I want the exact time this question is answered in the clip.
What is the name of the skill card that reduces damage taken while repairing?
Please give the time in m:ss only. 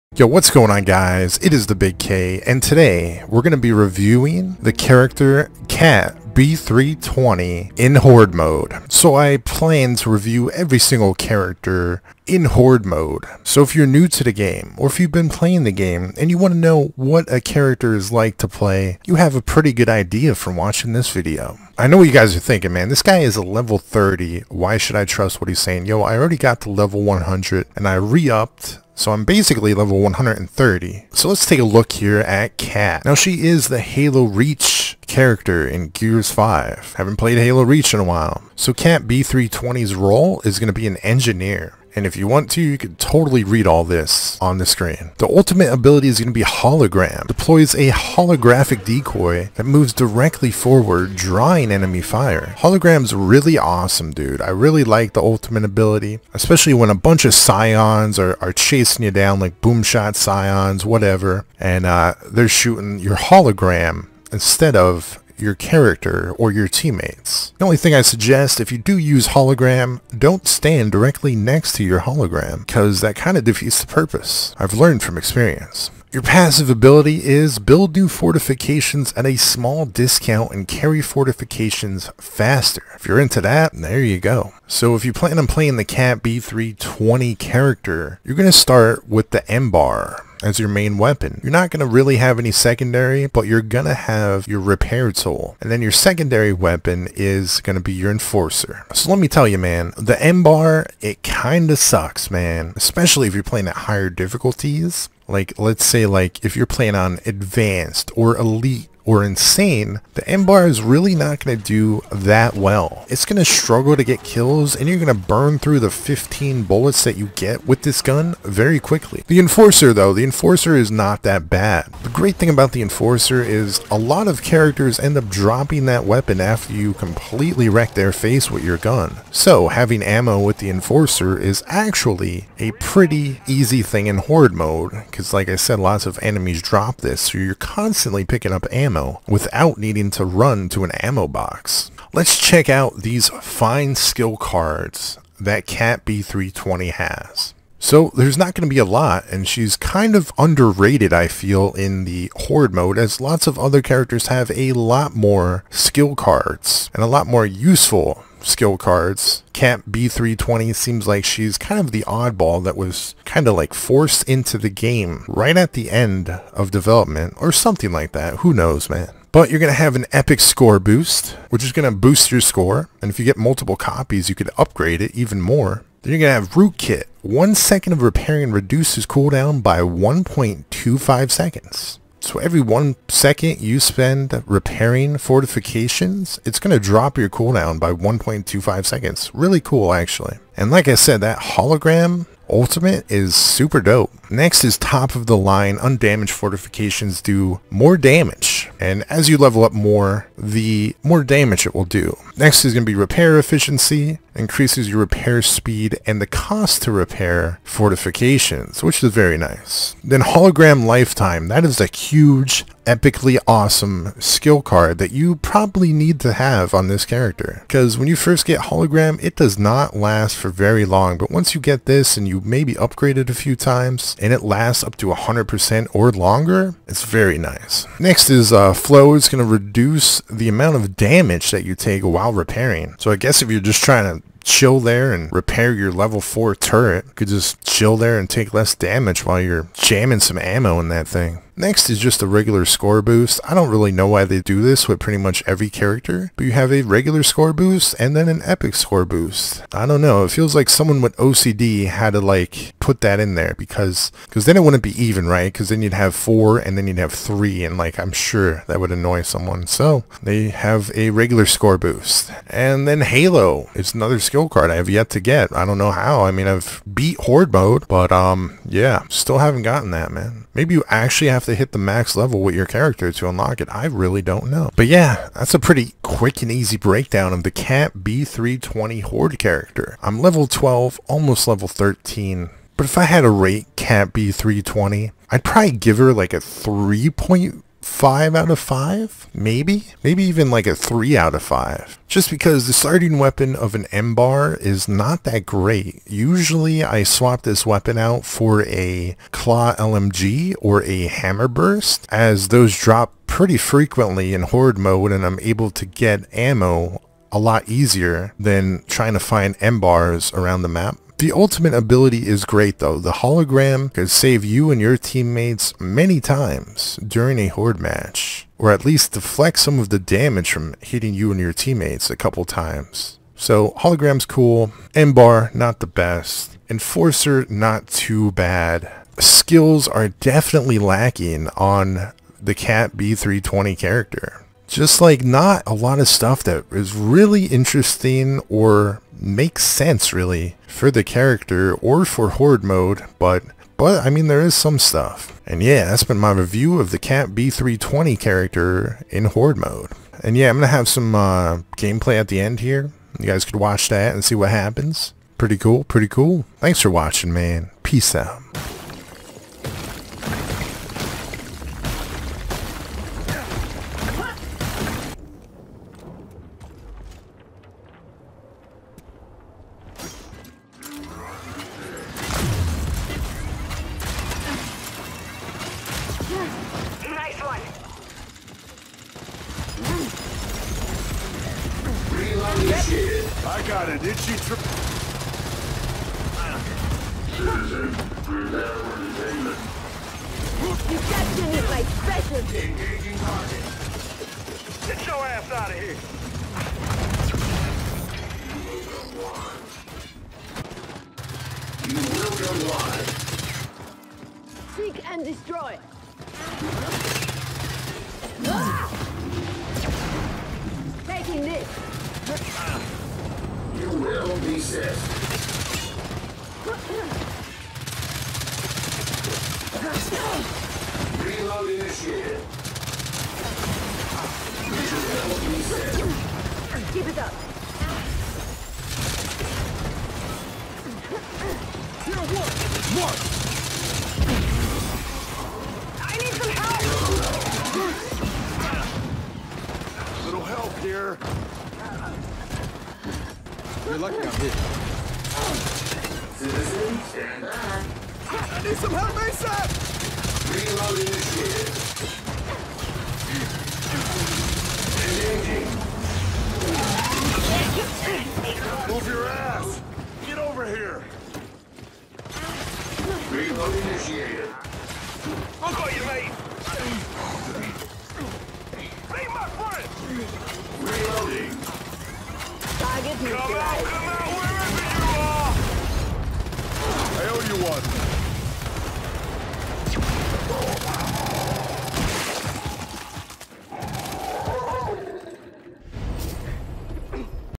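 3:48.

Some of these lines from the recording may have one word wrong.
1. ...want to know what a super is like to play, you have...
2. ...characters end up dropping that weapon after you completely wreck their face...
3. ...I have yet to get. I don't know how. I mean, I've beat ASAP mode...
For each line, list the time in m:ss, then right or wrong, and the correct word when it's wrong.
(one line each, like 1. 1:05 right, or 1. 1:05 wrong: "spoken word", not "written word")
1. 0:16 wrong: "character", not "super"
2. 2:04 right
3. 4:24 wrong: "Horde", not "ASAP".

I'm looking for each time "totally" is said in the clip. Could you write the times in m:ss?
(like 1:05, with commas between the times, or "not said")
0:42.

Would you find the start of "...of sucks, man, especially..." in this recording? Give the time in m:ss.
1:41.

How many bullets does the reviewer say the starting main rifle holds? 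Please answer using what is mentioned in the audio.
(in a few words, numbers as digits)
15.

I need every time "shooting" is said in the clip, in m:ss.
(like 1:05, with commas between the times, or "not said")
1:02.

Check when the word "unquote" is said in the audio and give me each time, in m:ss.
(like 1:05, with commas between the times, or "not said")
not said.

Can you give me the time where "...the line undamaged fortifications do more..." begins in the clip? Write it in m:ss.
3:15.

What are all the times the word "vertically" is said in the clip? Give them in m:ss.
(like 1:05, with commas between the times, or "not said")
not said.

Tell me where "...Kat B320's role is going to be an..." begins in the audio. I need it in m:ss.
0:38.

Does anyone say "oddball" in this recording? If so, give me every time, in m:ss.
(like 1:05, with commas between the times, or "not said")
2:42.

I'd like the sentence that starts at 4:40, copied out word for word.
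I'm level 12, almost level 13.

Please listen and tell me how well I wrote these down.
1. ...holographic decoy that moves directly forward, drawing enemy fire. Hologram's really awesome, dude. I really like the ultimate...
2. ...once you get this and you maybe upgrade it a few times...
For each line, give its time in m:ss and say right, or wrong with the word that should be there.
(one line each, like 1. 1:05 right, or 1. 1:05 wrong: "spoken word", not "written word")
1. 0:47 right
2. 3:41 right.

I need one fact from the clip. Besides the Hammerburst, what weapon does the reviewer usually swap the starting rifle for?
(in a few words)
Claw LMG.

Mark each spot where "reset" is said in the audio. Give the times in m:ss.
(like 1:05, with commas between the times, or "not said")
7:05.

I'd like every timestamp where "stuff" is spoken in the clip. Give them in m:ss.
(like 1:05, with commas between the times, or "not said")
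5:36, 5:44.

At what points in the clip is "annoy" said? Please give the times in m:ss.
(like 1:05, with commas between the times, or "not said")
4:18.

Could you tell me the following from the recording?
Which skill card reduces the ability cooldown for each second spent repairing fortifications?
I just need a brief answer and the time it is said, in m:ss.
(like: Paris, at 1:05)
Rootkit, at 2:56.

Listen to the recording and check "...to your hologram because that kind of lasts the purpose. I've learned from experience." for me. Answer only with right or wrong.
wrong.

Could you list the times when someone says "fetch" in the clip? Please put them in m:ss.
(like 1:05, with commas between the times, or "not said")
not said.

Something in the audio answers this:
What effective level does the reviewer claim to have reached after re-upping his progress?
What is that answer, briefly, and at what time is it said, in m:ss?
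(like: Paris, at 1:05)
130, at 0:29.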